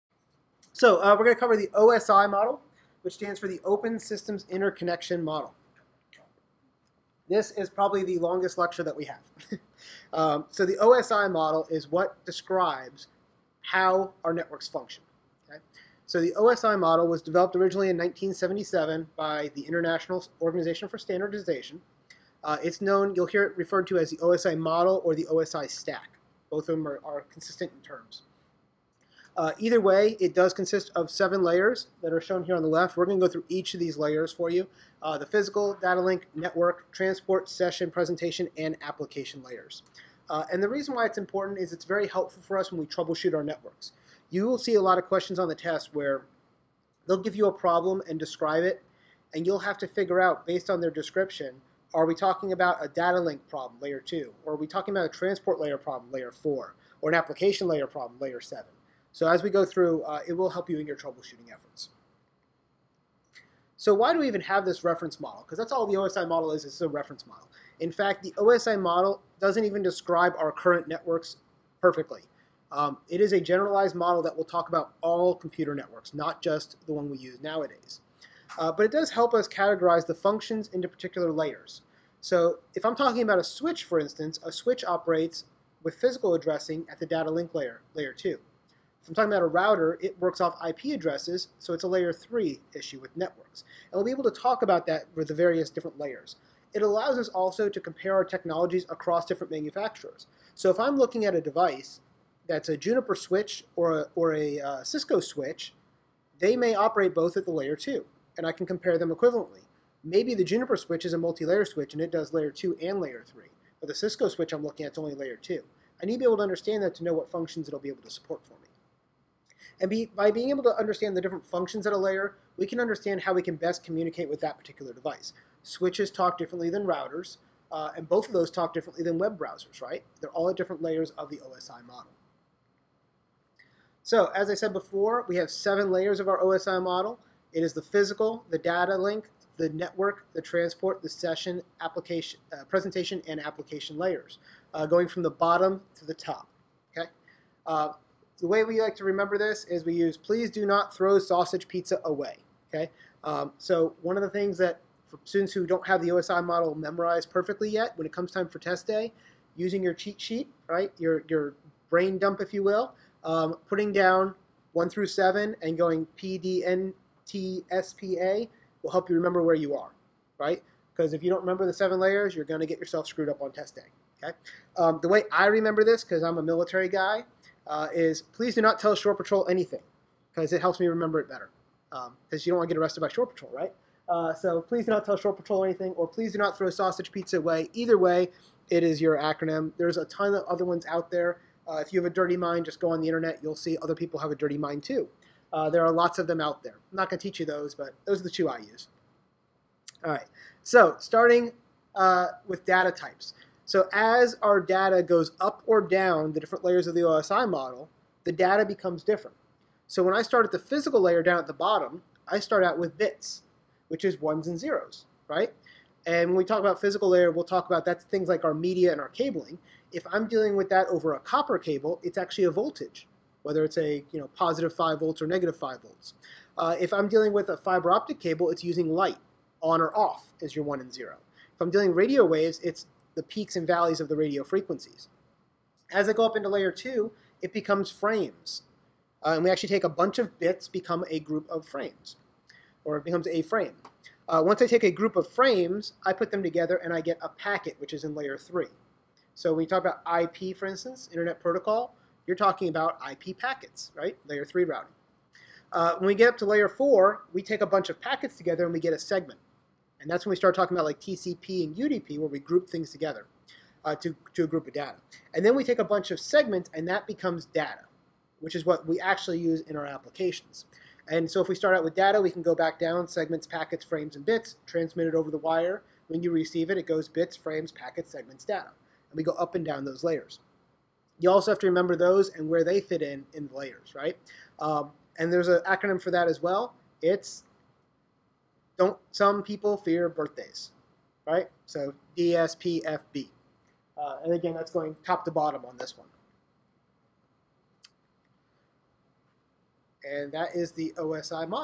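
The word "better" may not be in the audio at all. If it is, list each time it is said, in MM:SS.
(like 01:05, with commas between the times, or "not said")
03:01.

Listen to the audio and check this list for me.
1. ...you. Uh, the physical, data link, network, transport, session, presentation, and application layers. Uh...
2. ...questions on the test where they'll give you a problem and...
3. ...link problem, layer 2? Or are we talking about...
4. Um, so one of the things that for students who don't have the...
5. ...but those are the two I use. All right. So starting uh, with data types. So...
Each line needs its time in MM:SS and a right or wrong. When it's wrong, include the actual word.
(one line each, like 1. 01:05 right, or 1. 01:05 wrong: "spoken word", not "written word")
1. 00:34 right
2. 00:45 right
3. 00:53 right
4. 02:33 right
5. 03:17 right.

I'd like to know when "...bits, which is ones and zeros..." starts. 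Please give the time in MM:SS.
03:32.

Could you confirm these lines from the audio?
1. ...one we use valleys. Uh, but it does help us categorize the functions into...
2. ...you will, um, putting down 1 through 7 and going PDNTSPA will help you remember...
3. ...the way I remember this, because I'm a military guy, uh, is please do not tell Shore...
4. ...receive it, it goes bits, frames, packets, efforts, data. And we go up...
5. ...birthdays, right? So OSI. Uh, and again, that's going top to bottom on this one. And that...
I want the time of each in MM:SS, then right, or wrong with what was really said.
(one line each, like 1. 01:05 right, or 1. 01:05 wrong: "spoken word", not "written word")
1. 01:16 wrong: "nowadays", not "valleys"
2. 02:42 right
3. 02:55 right
4. 04:36 wrong: "segments", not "efforts"
5. 04:50 wrong: "DSPFB", not "OSI".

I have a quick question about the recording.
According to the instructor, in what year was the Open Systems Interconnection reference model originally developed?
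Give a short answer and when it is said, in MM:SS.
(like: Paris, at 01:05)
1977, at 00:17.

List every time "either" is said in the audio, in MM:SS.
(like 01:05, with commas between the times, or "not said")
00:29, 03:07.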